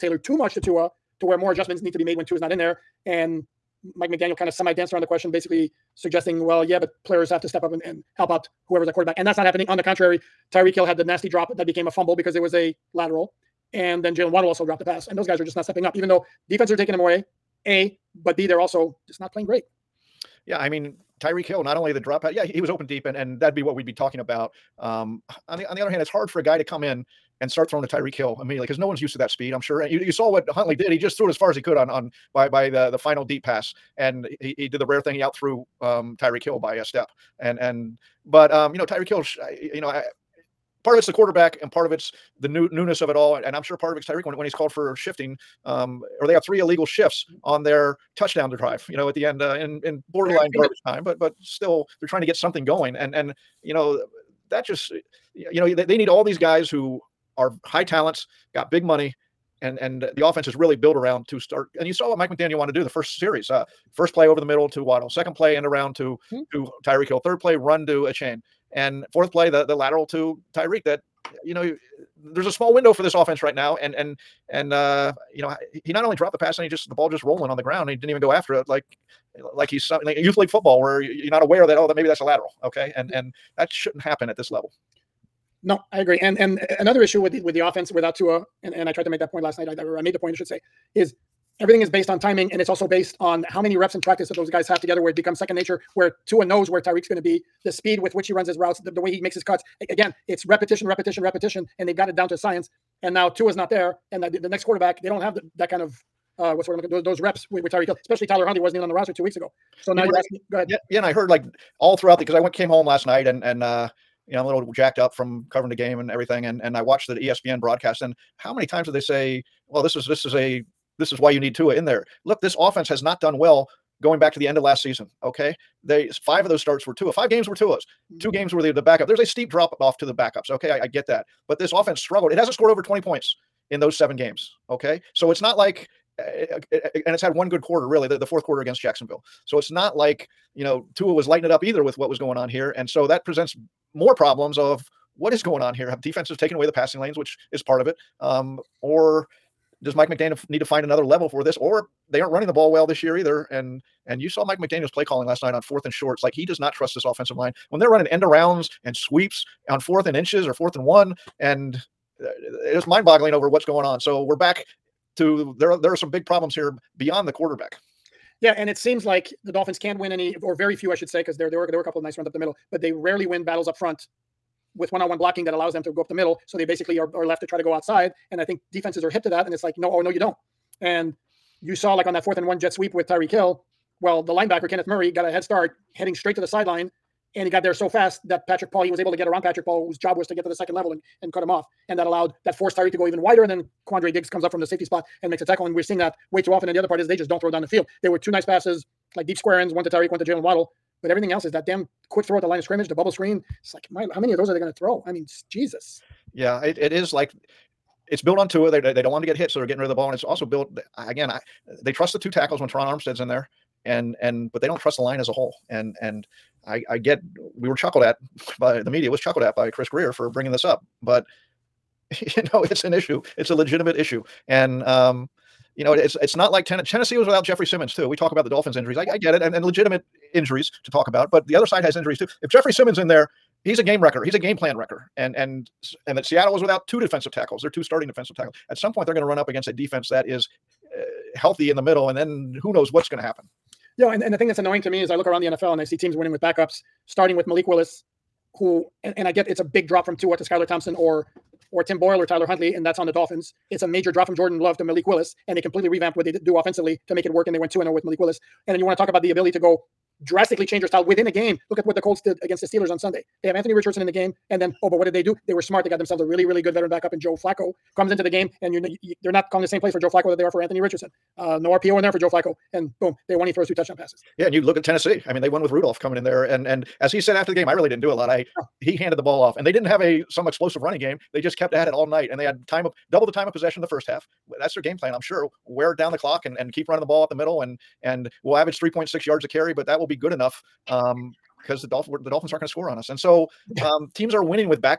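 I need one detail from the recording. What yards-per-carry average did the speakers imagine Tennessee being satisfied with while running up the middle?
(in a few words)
3.6.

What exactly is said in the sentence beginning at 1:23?
and that shouldn't happen at this level.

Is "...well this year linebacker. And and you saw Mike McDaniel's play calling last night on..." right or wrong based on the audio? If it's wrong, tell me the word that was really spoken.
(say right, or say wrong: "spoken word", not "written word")
wrong: "either", not "linebacker".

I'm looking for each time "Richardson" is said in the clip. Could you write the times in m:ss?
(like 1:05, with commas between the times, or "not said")
4:23, 4:30.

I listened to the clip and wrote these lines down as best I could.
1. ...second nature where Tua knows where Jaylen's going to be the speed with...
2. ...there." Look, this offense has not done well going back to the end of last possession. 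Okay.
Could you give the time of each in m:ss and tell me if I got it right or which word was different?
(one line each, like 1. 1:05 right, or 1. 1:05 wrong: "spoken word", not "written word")
1. 1:35 wrong: "Tyreek", not "Jaylen"
2. 2:01 wrong: "season", not "possession".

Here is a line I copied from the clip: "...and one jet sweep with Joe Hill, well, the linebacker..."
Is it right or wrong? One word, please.
wrong.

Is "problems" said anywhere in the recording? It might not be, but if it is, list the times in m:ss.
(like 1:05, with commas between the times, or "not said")
2:24, 2:46.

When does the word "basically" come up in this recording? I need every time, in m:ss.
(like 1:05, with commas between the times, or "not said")
0:05, 2:56.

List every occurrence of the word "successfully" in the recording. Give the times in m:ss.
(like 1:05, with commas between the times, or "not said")
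not said.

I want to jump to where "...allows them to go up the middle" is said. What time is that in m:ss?
2:55.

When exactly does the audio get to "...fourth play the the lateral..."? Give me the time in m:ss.
1:09.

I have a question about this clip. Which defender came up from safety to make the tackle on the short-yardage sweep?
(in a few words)
Quandre Diggs.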